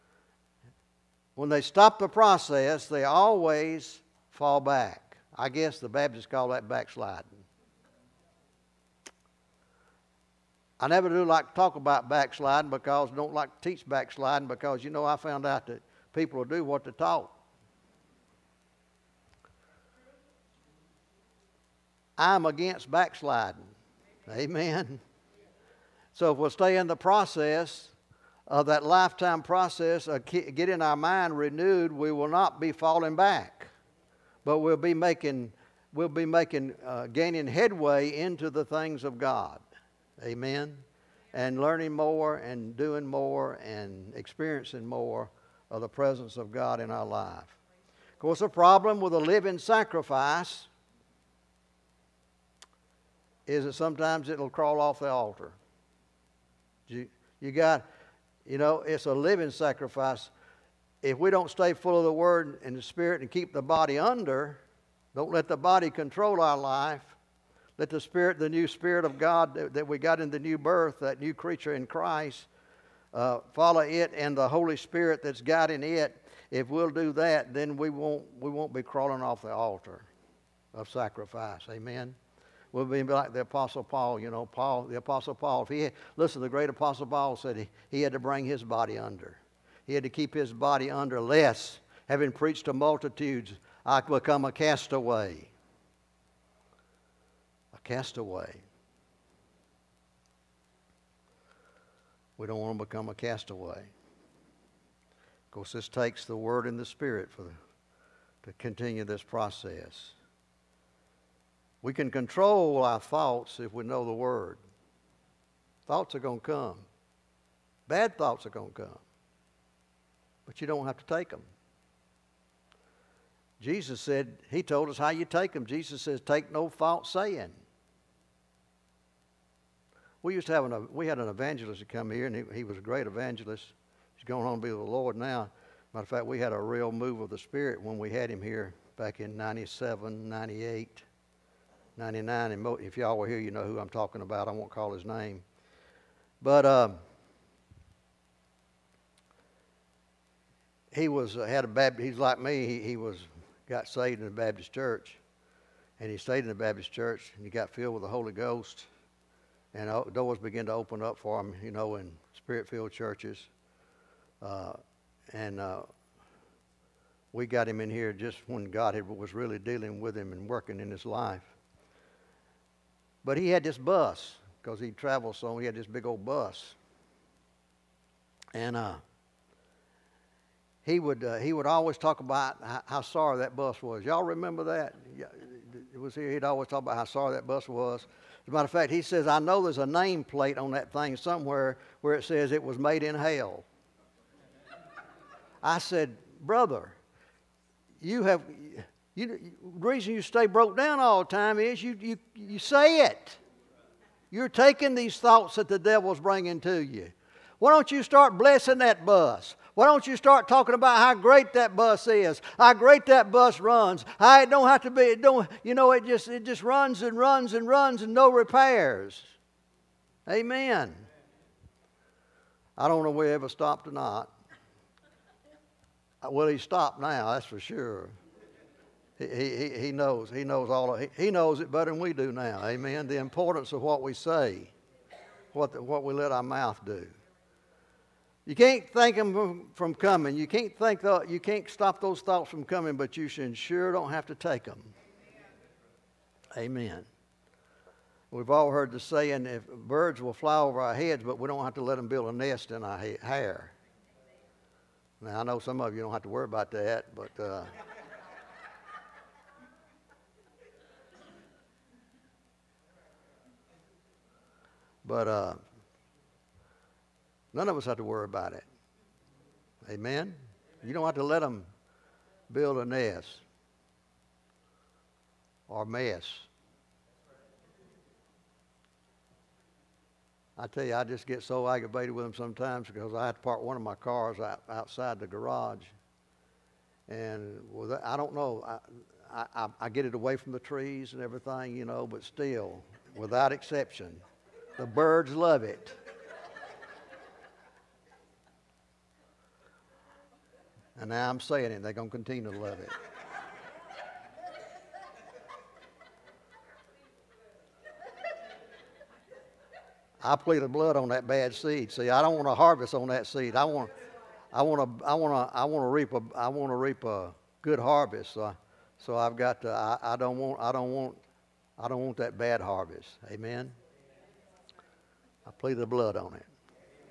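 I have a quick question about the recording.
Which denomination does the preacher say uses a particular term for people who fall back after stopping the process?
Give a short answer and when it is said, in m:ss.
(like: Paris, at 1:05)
Baptists, at 0:05.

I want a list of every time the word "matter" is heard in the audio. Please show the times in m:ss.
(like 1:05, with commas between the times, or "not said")
2:15, 3:08.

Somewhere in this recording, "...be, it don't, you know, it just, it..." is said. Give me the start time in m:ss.
3:34.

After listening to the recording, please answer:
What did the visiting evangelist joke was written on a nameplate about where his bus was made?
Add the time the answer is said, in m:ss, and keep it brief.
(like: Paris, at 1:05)
made in hell, at 3:12.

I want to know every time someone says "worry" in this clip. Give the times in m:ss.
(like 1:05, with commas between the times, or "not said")
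4:16, 4:28.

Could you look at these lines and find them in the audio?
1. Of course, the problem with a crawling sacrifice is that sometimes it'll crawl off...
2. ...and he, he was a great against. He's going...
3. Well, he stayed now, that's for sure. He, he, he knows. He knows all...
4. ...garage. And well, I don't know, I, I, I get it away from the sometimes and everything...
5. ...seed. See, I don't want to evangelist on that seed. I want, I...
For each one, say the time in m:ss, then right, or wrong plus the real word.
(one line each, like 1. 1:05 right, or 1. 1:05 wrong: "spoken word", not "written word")
1. 0:48 wrong: "living", not "crawling"
2. 2:12 wrong: "evangelist", not "against"
3. 3:46 wrong: "stopped", not "stayed"
4. 4:45 wrong: "trees", not "sometimes"
5. 5:11 wrong: "harvest", not "evangelist".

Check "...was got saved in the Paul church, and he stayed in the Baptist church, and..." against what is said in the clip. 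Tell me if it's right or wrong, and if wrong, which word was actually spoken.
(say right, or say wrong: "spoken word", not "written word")
wrong: "Baptist", not "Paul".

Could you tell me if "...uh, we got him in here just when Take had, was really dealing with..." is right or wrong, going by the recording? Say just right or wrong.
wrong.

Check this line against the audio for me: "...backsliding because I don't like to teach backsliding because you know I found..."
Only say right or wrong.
right.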